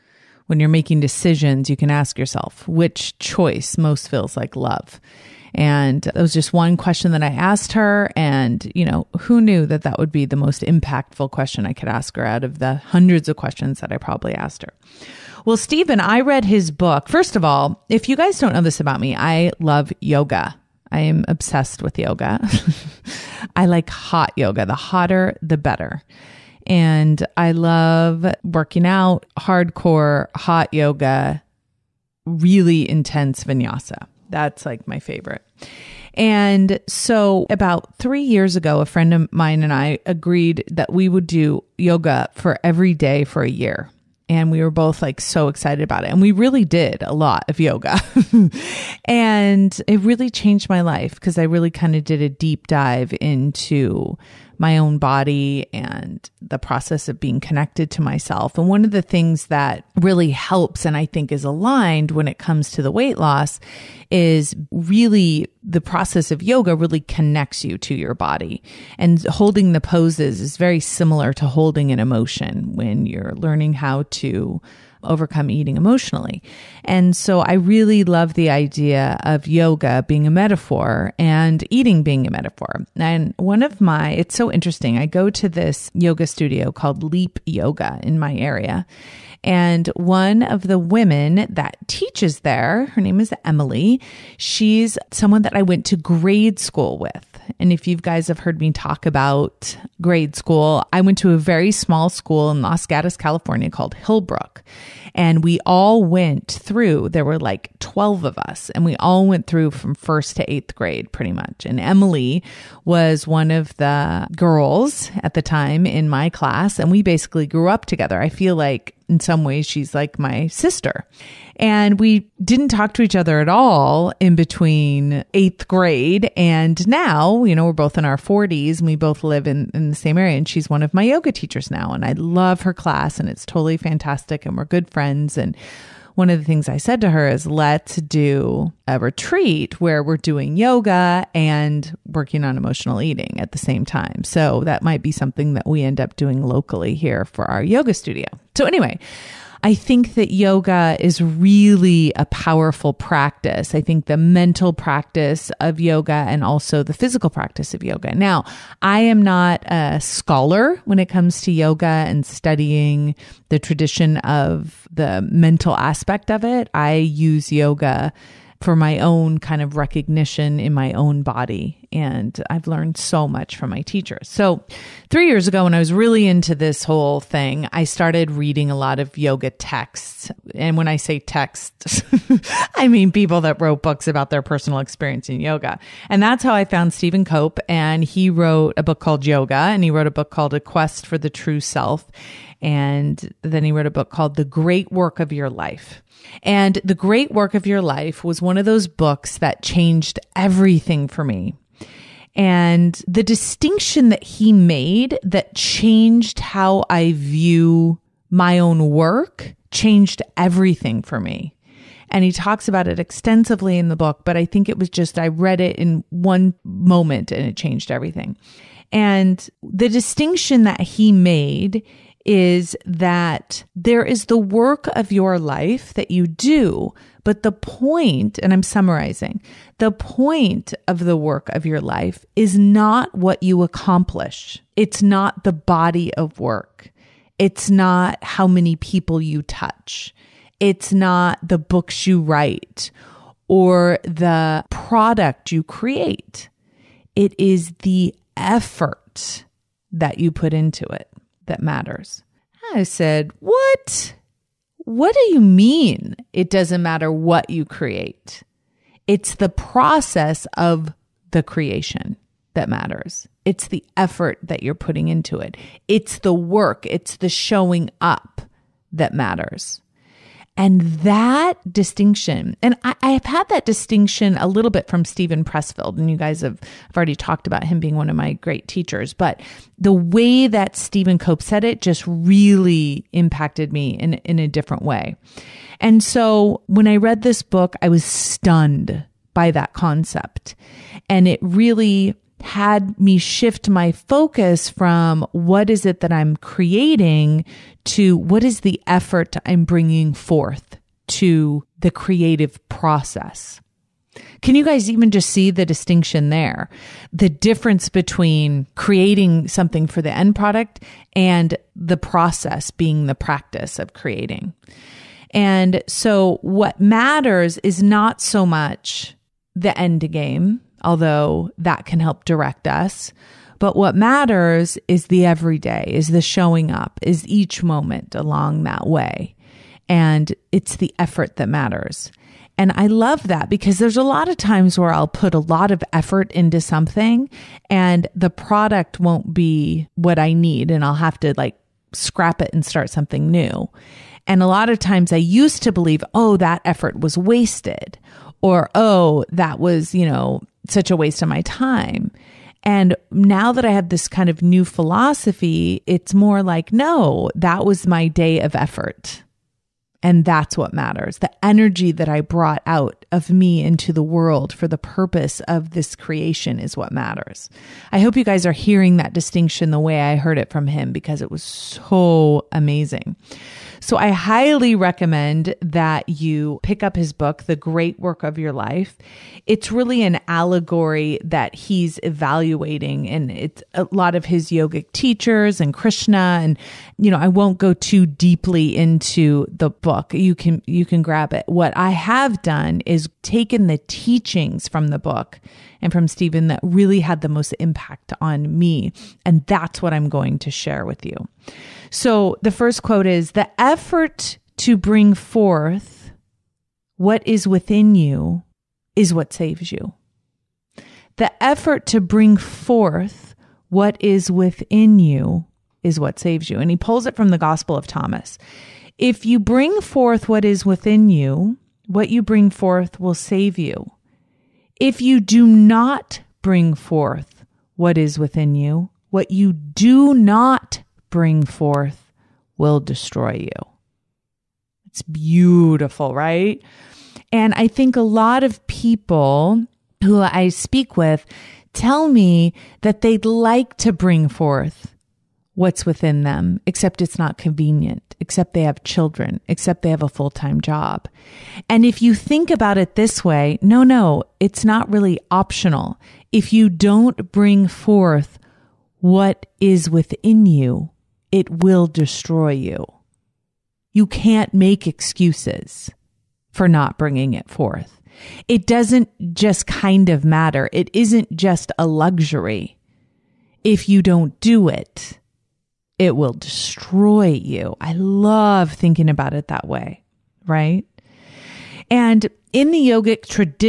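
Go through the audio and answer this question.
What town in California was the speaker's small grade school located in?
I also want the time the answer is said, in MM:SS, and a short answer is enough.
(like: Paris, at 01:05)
Los Gatos, at 01:42.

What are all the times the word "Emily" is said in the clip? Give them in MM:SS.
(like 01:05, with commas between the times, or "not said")
01:33, 01:51.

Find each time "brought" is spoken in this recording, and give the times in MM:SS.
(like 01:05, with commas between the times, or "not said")
06:02.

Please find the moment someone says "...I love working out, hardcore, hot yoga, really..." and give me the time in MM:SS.
00:27.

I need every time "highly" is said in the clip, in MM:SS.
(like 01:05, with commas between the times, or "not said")
06:14.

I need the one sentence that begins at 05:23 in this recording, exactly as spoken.
But what matters is the everyday, is the showing up, is each moment along that way.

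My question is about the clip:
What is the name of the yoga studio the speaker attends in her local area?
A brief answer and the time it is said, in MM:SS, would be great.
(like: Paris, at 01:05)
Leap Yoga, at 01:27.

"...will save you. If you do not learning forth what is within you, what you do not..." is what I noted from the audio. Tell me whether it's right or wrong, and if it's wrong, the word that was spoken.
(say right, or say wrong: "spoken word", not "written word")
wrong: "bring", not "learning".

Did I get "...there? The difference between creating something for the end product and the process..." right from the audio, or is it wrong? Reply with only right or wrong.
right.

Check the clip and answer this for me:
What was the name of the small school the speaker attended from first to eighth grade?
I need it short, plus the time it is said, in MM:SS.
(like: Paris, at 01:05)
Hillbrook, at 01:43.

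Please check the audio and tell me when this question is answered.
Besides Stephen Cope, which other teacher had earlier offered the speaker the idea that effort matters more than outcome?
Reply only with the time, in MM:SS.
04:35.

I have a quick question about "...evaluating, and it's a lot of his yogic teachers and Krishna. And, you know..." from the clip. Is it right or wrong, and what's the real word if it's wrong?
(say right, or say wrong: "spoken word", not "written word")
right.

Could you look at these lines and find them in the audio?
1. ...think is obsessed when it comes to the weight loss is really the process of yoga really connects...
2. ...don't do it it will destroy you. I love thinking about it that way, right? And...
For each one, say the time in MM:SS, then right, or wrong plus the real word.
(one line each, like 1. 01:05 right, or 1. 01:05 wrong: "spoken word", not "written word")
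1. 01:01 wrong: "aligned", not "obsessed"
2. 07:54 right.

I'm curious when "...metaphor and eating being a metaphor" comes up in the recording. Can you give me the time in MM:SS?
01:20.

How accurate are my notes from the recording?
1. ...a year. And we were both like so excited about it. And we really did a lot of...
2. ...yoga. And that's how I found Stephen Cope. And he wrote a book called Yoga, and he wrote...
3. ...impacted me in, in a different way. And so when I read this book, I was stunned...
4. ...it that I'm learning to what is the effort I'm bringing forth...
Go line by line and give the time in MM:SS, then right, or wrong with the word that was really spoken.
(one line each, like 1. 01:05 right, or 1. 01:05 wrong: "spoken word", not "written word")
1. 00:43 right
2. 03:05 right
3. 04:43 right
4. 04:55 wrong: "creating", not "learning".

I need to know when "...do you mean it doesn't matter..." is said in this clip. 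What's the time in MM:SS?
04:15.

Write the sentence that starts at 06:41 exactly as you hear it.
So the first quote is the effort to bring forth what is within you is what saves you.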